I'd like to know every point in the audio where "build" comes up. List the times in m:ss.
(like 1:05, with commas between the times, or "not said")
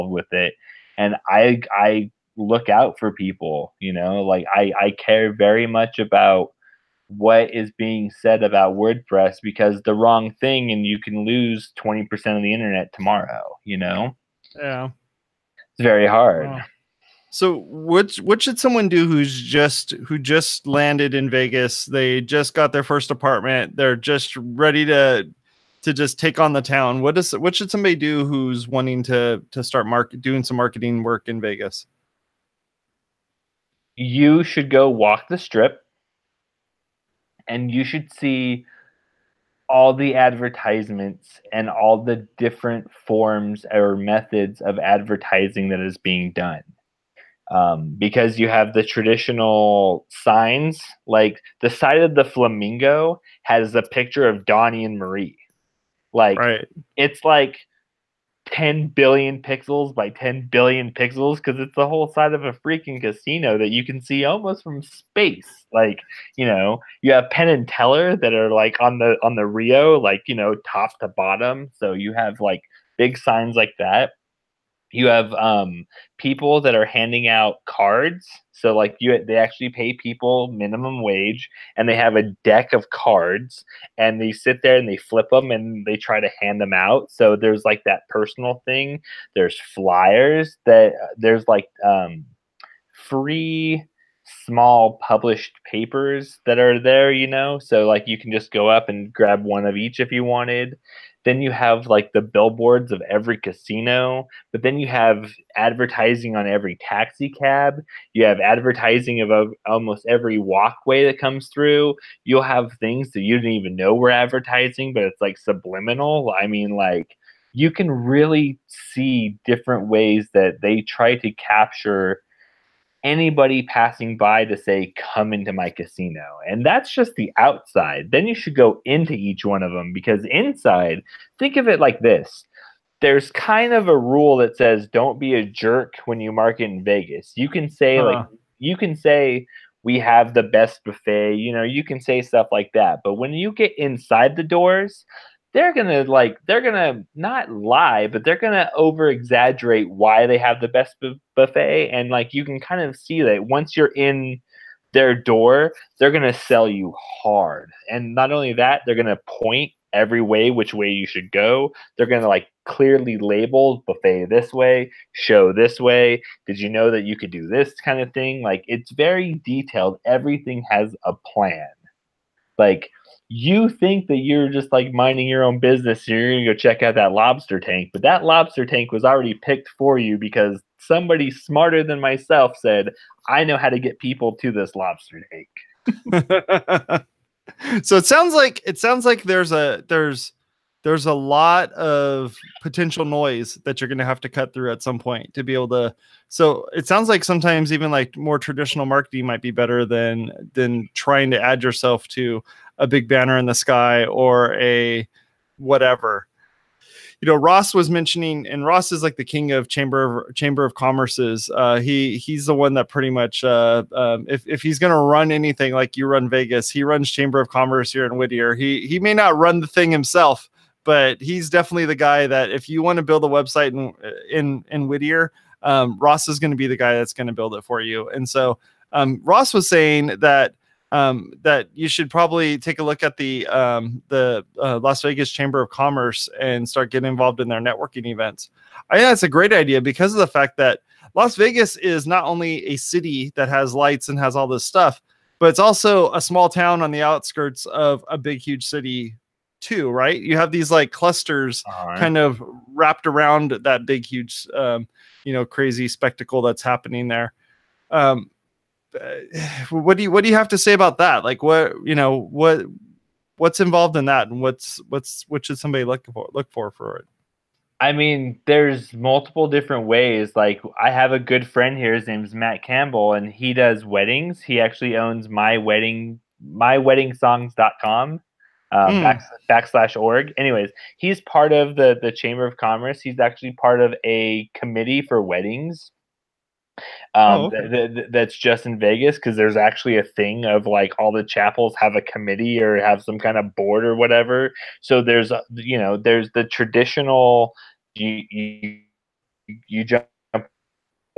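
3:43, 3:47.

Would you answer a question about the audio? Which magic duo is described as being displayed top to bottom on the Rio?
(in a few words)
Penn and Teller.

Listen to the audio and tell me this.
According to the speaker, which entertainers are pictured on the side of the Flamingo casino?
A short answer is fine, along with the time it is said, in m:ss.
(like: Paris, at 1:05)
Donnie and Marie, at 0:54.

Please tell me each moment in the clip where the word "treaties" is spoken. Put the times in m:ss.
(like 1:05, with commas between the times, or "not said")
not said.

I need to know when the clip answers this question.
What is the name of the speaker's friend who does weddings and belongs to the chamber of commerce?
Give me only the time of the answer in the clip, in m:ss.
4:32.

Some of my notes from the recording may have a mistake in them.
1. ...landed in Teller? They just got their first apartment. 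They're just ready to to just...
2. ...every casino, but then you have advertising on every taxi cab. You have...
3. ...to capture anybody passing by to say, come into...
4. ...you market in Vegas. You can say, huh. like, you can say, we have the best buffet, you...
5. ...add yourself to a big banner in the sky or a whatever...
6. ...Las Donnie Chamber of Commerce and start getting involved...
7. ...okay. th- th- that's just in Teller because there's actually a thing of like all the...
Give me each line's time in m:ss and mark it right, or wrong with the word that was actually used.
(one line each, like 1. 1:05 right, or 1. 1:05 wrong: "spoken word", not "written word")
1. 0:20 wrong: "Vegas", not "Teller"
2. 1:43 right
3. 2:01 right
4. 2:16 right
5. 3:21 right
6. 3:54 wrong: "Vegas", not "Donnie"
7. 4:47 wrong: "Vegas", not "Teller".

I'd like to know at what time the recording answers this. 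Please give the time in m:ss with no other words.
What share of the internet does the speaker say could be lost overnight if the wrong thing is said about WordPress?
0:11.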